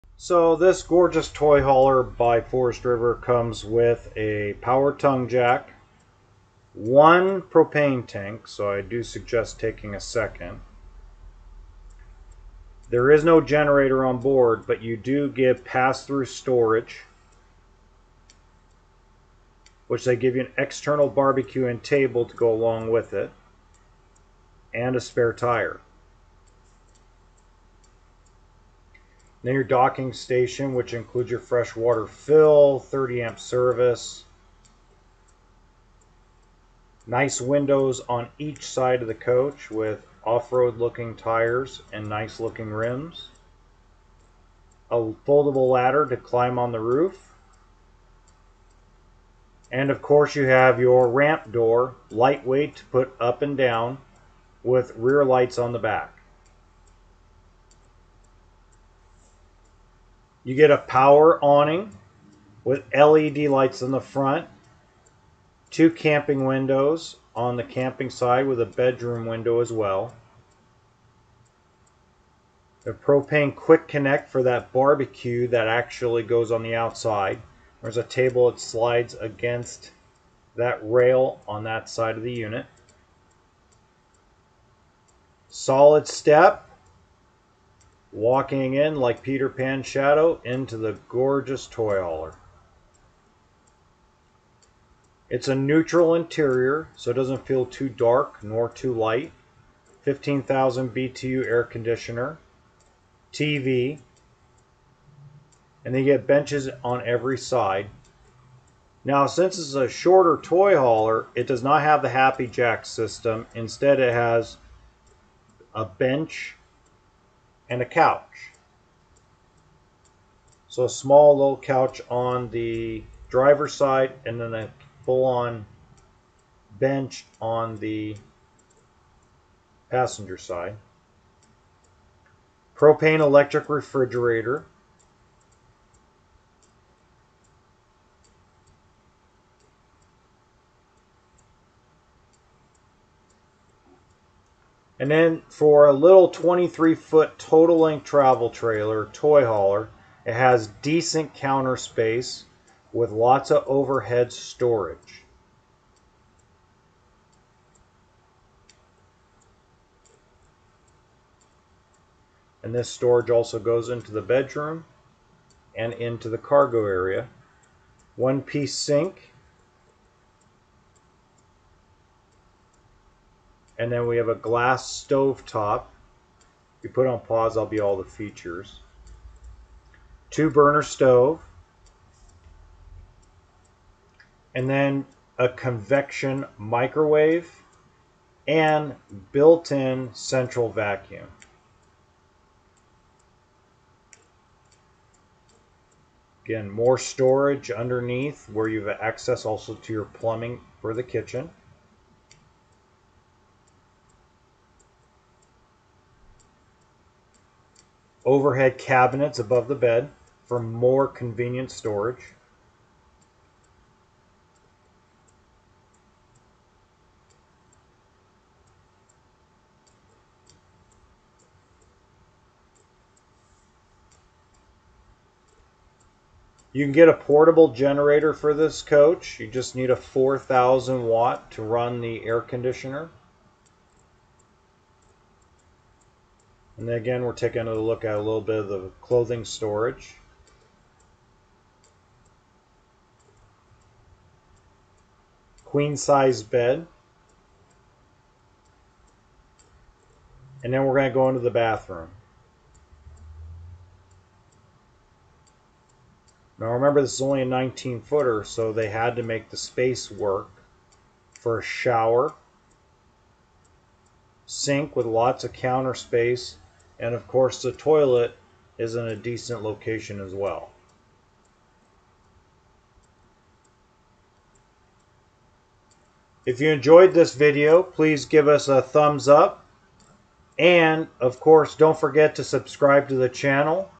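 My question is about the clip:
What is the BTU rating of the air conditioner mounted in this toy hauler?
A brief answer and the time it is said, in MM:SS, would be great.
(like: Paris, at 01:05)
15,000 BTU, at 01:40.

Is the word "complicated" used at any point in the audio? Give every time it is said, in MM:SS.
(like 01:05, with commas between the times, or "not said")
not said.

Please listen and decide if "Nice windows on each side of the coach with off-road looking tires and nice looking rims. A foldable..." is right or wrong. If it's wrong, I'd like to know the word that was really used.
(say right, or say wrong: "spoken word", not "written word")
right.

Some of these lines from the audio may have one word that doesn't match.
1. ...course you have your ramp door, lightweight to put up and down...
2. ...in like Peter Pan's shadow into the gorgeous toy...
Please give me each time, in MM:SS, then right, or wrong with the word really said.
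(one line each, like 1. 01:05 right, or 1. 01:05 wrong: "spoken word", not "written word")
1. 00:50 right
2. 01:28 right.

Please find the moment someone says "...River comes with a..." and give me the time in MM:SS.
00:02.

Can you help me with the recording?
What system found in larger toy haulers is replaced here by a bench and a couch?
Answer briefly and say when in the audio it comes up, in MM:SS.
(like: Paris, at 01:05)
HappiJac system, at 01:52.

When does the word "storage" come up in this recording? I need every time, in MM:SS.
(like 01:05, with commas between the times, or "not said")
00:16, 02:34, 02:42, 03:16, 03:31, 03:59.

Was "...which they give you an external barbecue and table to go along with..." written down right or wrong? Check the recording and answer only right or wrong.
right.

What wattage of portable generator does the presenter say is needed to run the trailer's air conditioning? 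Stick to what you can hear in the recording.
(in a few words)
4,000 watt.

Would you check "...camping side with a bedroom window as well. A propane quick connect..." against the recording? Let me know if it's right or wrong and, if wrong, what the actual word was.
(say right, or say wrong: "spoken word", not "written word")
right.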